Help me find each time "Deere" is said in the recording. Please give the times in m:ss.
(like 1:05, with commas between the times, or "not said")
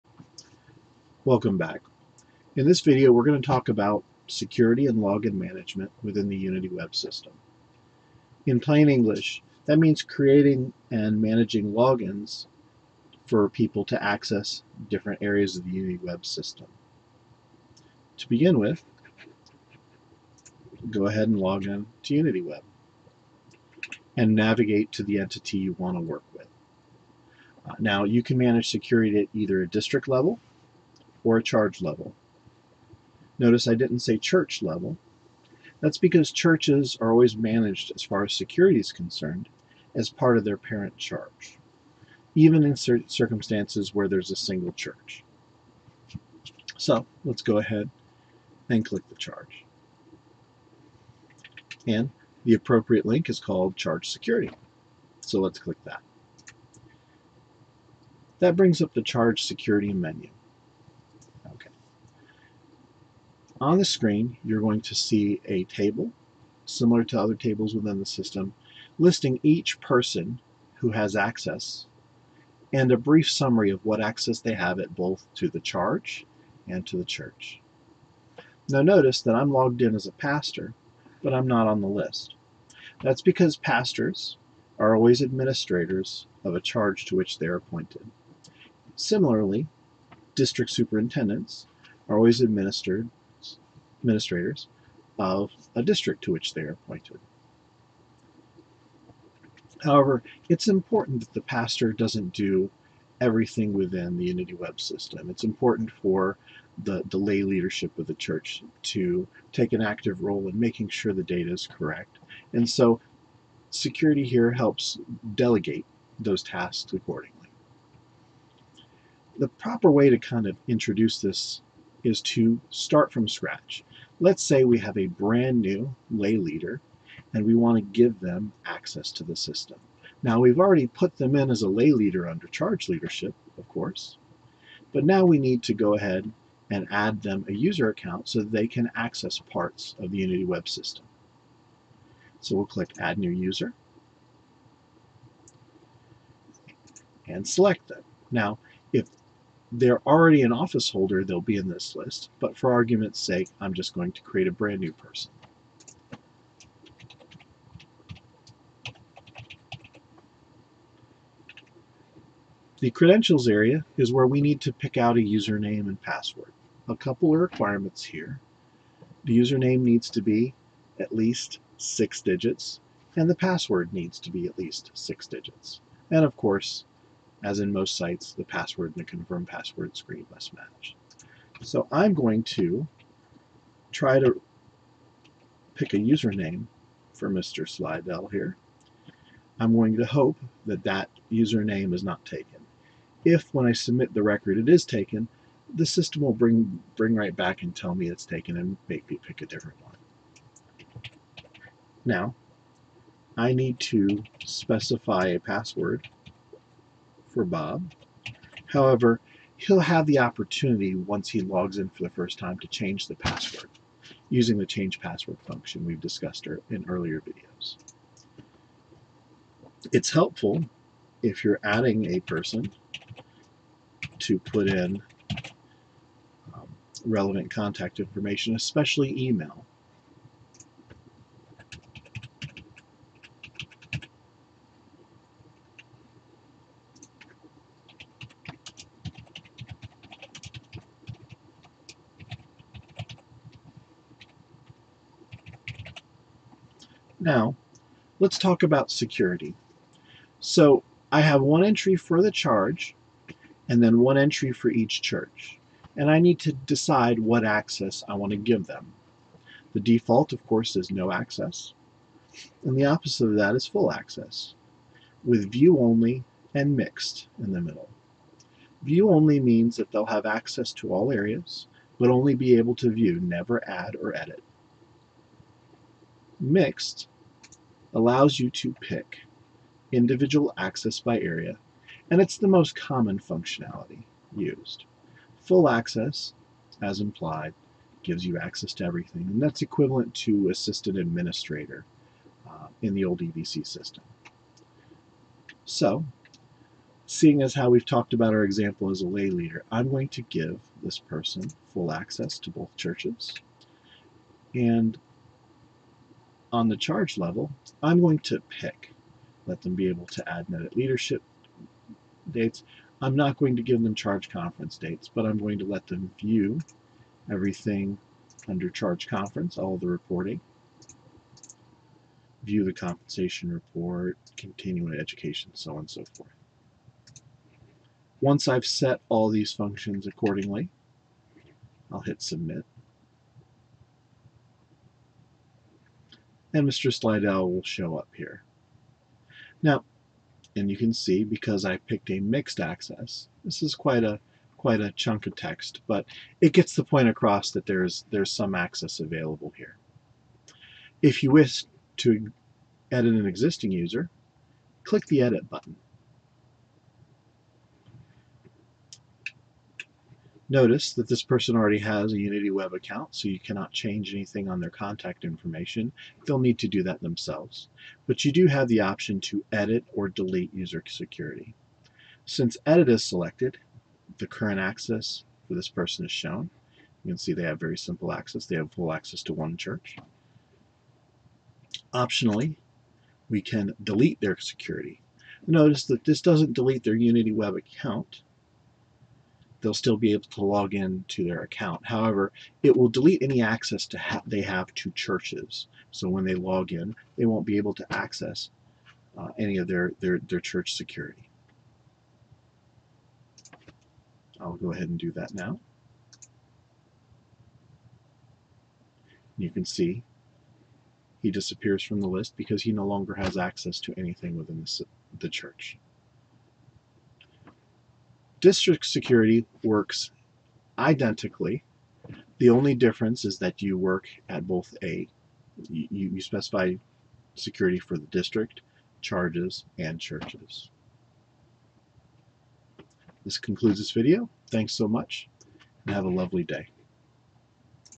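not said.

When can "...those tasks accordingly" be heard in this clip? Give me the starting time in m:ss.
1:56.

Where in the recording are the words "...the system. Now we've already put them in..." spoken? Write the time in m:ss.
2:09.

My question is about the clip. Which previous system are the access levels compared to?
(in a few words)
EVC.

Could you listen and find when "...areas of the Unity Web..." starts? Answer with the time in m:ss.
0:15.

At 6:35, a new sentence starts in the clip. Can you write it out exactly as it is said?
So when they log in, they won't be able to access uh, any of their, their, their church security.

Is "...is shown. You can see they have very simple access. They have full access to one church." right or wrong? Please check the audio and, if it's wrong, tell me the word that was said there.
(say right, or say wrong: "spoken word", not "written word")
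right.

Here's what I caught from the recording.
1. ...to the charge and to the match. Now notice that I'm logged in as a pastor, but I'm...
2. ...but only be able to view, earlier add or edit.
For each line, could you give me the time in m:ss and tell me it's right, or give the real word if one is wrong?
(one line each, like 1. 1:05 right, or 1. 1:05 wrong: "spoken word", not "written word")
1. 1:15 wrong: "church", not "match"
2. 4:31 wrong: "never", not "earlier".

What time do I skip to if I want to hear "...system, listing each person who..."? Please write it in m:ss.
1:08.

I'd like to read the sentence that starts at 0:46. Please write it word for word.
So let's go ahead and click the charge.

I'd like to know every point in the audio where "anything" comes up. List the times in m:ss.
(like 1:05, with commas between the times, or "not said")
6:04, 6:53.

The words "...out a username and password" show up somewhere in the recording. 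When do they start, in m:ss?
2:44.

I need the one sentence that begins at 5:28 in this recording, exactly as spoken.
Once I've set all these functions accordingly, I'll hit submit.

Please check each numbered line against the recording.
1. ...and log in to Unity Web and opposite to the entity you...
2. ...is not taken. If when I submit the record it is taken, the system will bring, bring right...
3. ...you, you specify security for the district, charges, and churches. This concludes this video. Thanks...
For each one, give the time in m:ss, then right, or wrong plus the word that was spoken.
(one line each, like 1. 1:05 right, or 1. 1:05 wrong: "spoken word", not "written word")
1. 0:21 wrong: "navigate", not "opposite"
2. 3:11 right
3. 7:05 right.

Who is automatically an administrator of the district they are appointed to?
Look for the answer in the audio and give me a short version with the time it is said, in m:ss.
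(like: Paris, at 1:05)
District superintendents, at 1:30.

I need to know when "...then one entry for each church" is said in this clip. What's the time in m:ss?
4:13.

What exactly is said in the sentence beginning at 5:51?
If you wish to edit an existing user, click the edit button.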